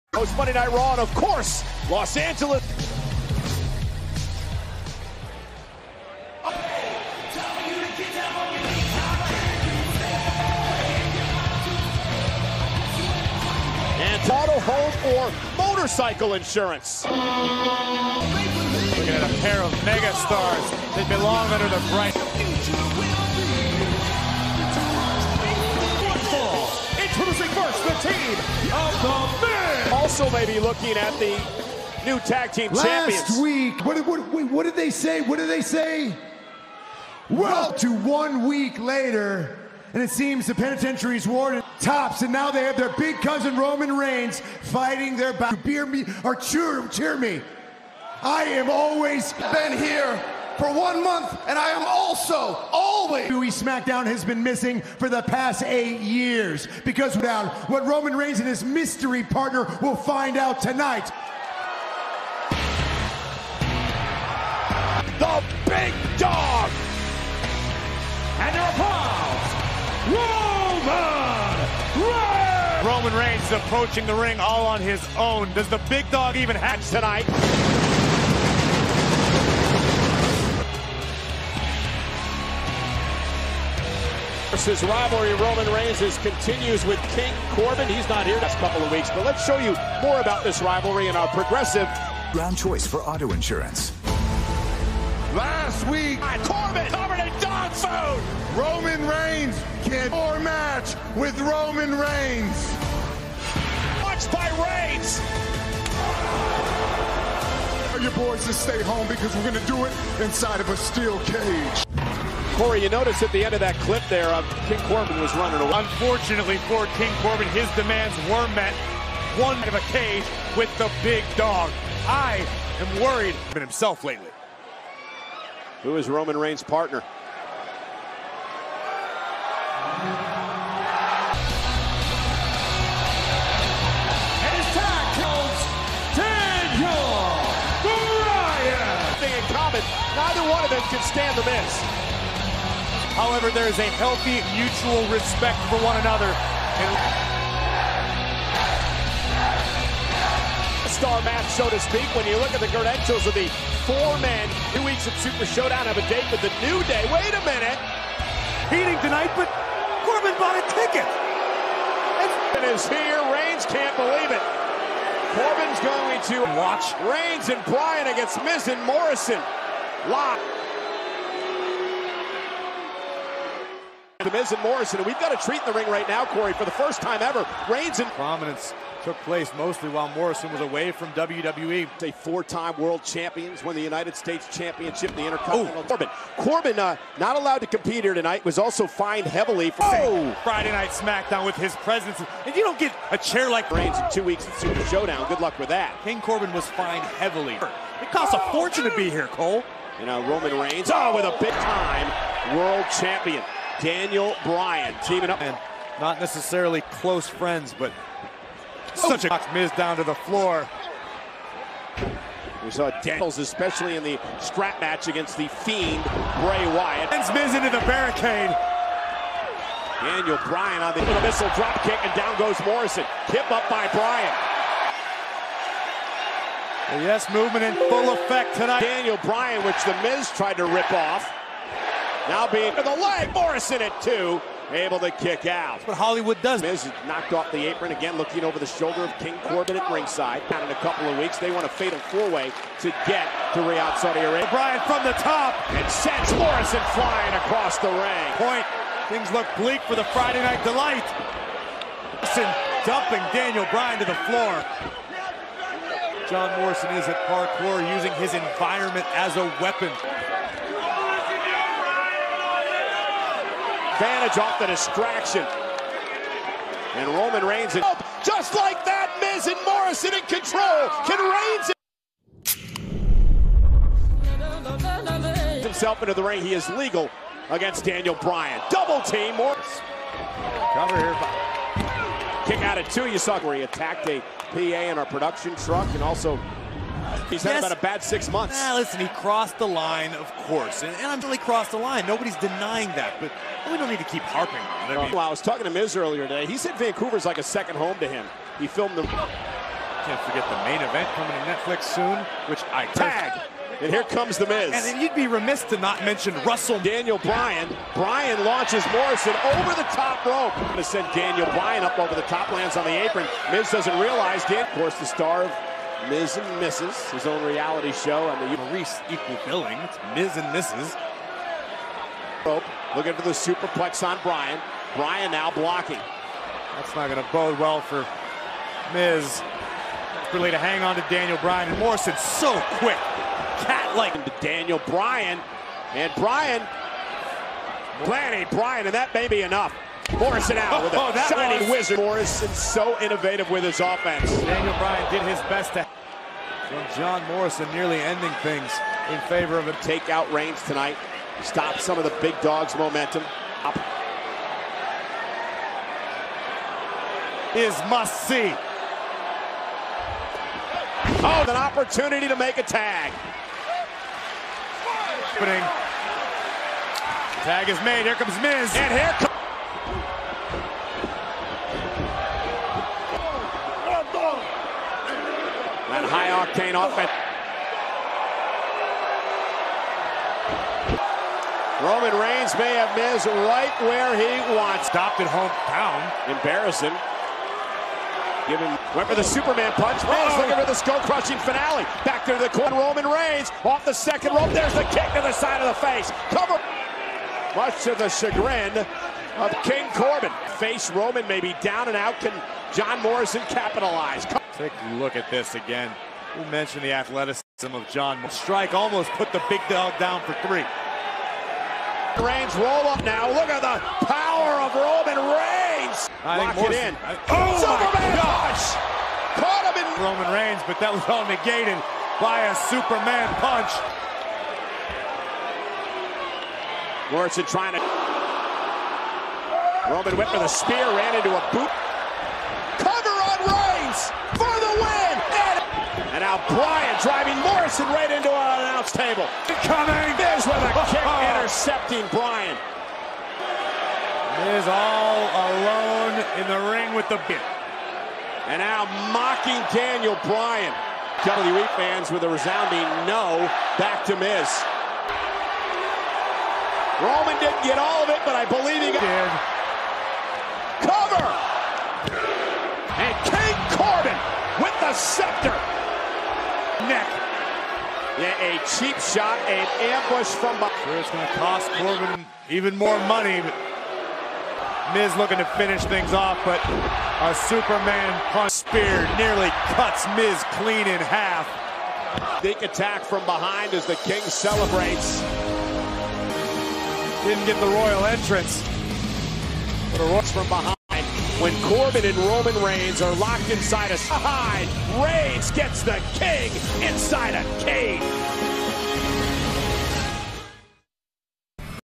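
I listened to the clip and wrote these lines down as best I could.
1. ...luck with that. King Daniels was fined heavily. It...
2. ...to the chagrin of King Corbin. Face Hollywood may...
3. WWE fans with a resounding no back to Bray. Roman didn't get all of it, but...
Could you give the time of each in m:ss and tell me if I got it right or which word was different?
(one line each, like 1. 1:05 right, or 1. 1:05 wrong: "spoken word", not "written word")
1. 3:15 wrong: "Corbin", not "Daniels"
2. 6:37 wrong: "Roman", not "Hollywood"
3. 7:31 wrong: "Miz", not "Bray".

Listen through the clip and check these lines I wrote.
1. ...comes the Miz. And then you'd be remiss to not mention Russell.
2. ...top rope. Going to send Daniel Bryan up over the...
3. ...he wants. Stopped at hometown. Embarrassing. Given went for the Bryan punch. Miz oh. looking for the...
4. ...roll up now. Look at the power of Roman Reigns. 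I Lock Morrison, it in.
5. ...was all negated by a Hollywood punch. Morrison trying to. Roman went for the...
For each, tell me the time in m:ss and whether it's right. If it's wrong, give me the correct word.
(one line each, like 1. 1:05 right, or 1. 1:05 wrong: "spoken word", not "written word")
1. 5:04 right
2. 5:09 right
3. 6:24 wrong: "Superman", not "Bryan"
4. 6:52 right
5. 7:00 wrong: "Superman", not "Hollywood".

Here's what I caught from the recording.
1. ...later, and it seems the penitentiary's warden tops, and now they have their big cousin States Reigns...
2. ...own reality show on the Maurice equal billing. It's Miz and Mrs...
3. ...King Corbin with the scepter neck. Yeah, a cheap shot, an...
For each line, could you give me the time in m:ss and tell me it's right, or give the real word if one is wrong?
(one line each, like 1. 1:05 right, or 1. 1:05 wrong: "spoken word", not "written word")
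1. 0:38 wrong: "Roman", not "States"
2. 5:17 right
3. 7:43 right.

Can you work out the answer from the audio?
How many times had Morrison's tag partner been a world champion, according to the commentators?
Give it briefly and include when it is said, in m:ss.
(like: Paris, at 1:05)
4, at 3:02.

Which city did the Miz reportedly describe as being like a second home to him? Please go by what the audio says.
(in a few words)
Vancouver.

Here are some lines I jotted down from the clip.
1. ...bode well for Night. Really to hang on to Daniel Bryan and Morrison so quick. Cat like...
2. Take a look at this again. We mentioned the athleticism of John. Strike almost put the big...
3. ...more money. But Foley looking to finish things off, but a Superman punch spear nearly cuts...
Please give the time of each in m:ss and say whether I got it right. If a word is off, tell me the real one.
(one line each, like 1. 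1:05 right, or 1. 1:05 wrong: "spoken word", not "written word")
1. 5:27 wrong: "Miz", not "Night"
2. 6:44 right
3. 7:52 wrong: "Miz", not "Foley".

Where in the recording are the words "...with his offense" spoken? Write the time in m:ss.
5:43.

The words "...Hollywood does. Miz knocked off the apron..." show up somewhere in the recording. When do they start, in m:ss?
3:55.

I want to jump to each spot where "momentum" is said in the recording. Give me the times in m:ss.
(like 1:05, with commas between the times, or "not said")
5:52.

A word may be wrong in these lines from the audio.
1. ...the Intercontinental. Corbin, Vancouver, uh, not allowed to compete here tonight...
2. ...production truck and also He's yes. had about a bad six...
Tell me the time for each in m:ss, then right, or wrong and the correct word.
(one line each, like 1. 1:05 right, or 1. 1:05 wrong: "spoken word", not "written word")
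1. 3:05 wrong: "Corbin", not "Vancouver"
2. 4:45 right.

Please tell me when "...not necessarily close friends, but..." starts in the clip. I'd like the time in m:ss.
3:25.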